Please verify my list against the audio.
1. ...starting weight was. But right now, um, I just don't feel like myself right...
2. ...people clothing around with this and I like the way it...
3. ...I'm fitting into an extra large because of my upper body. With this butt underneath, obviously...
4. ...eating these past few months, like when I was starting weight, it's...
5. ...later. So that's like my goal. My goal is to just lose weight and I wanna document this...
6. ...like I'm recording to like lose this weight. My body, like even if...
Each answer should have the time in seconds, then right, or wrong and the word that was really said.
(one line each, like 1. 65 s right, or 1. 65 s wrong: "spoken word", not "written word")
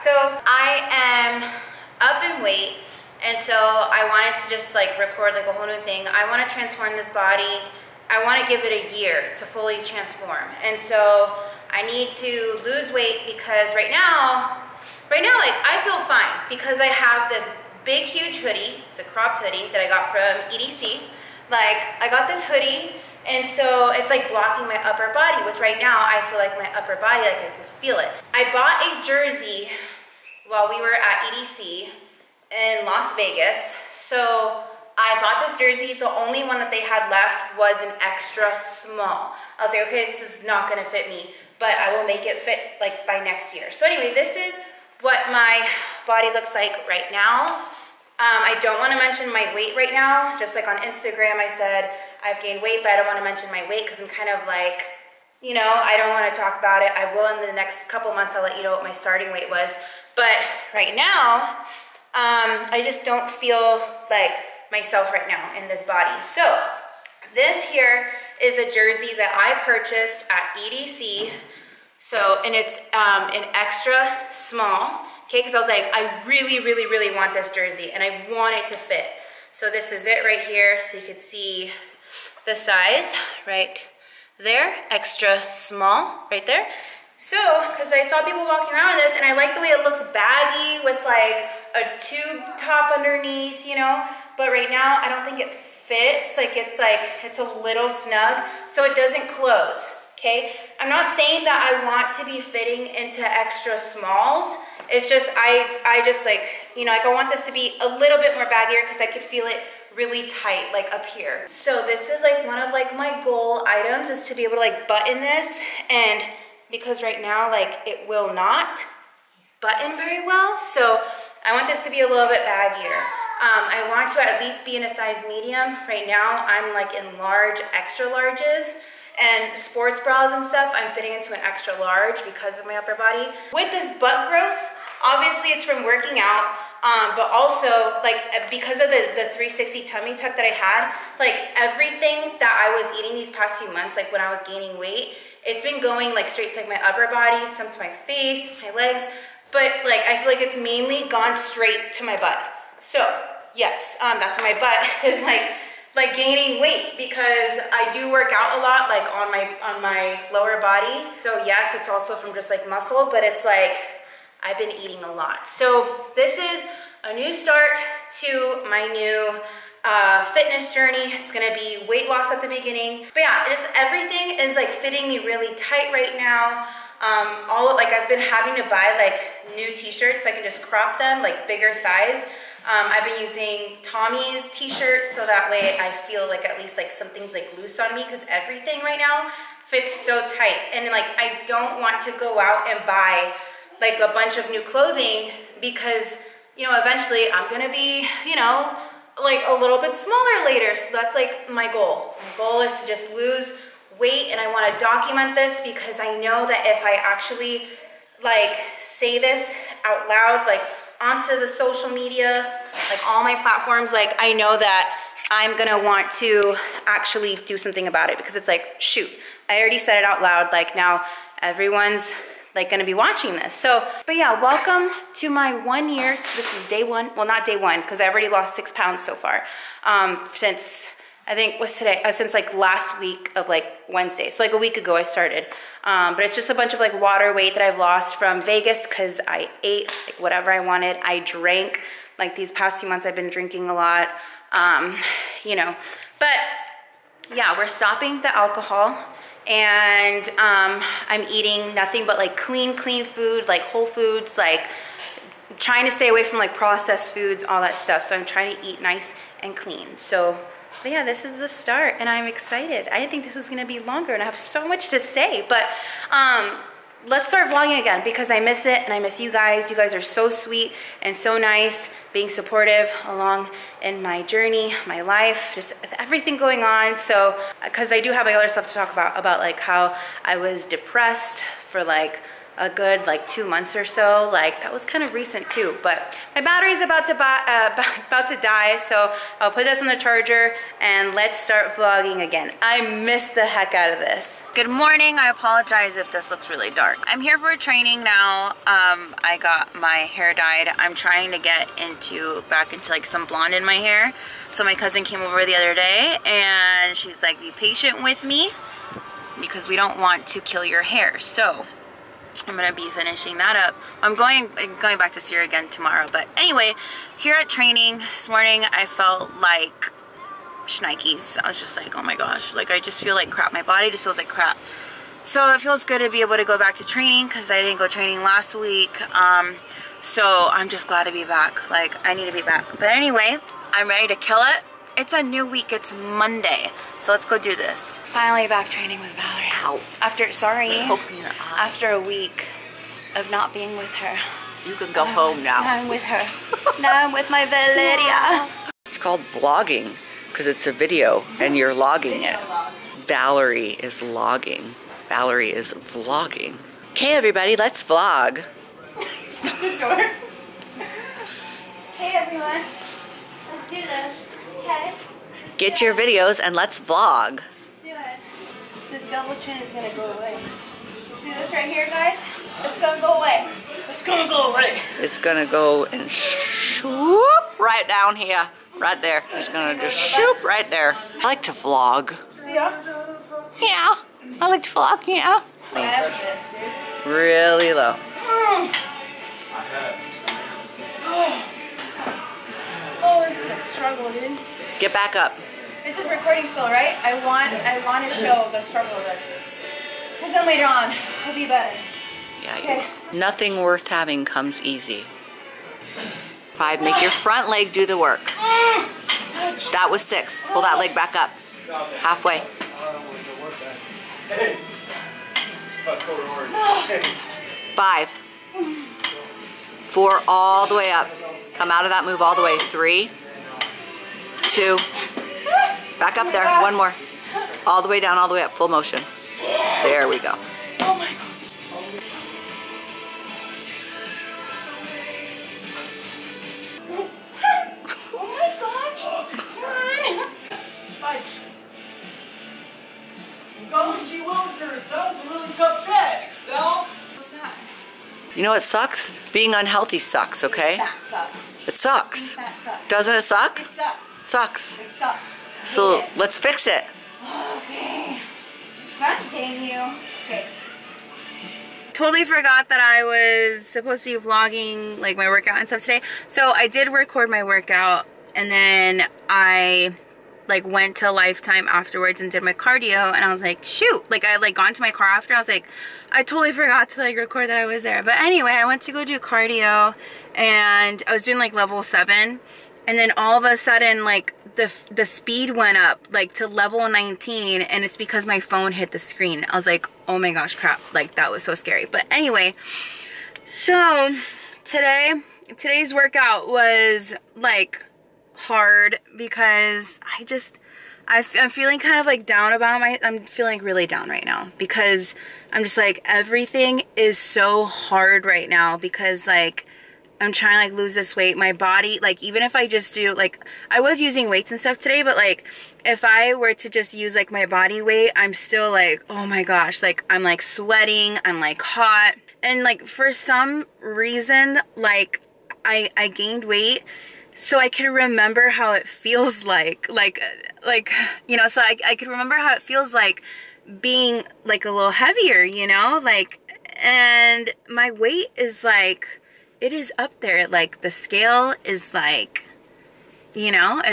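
1. 58 s right
2. 88 s wrong: "walking", not "clothing"
3. 130 s wrong: "growth", not "underneath"
4. 142 s wrong: "gaining", not "starting"
5. 200 s right
6. 509 s wrong: "trying", not "recording".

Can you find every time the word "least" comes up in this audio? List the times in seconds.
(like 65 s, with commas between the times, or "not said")
124 s, 186 s.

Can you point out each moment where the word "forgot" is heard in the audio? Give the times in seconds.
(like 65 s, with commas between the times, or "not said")
462 s, 476 s.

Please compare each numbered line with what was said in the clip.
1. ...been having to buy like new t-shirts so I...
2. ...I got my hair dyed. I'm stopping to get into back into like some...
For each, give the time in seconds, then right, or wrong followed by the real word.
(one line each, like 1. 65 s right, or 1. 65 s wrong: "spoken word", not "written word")
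1. 178 s right
2. 299 s wrong: "trying", not "stopping".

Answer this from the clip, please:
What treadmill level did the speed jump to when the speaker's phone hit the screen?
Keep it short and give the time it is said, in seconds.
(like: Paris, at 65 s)
19, at 486 s.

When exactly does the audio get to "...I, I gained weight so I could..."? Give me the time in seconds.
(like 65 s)
525 s.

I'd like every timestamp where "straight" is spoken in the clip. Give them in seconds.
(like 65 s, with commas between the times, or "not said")
146 s, 151 s.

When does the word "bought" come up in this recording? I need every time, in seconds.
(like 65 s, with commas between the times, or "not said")
28 s, 35 s.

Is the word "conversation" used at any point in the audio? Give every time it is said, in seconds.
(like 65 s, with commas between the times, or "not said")
not said.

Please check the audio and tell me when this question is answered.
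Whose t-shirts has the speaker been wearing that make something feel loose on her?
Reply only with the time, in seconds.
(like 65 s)
183 s.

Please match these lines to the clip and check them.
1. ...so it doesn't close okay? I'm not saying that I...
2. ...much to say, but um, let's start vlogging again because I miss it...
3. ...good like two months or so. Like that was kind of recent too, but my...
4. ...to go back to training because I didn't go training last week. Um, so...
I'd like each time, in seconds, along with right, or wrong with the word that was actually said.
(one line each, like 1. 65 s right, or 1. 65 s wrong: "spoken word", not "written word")
1. 98 s right
2. 264 s right
3. 282 s right
4. 326 s right.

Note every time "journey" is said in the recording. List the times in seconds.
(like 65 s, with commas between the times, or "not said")
170 s, 274 s.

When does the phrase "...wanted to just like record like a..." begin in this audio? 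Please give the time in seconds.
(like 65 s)
4 s.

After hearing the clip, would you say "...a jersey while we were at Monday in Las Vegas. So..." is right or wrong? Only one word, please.
wrong.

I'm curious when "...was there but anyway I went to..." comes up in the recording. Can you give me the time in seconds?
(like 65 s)
477 s.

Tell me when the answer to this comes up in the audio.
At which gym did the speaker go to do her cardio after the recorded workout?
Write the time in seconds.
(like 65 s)
471 s.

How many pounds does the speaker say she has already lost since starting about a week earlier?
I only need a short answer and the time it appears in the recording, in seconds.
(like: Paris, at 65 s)
6, at 228 s.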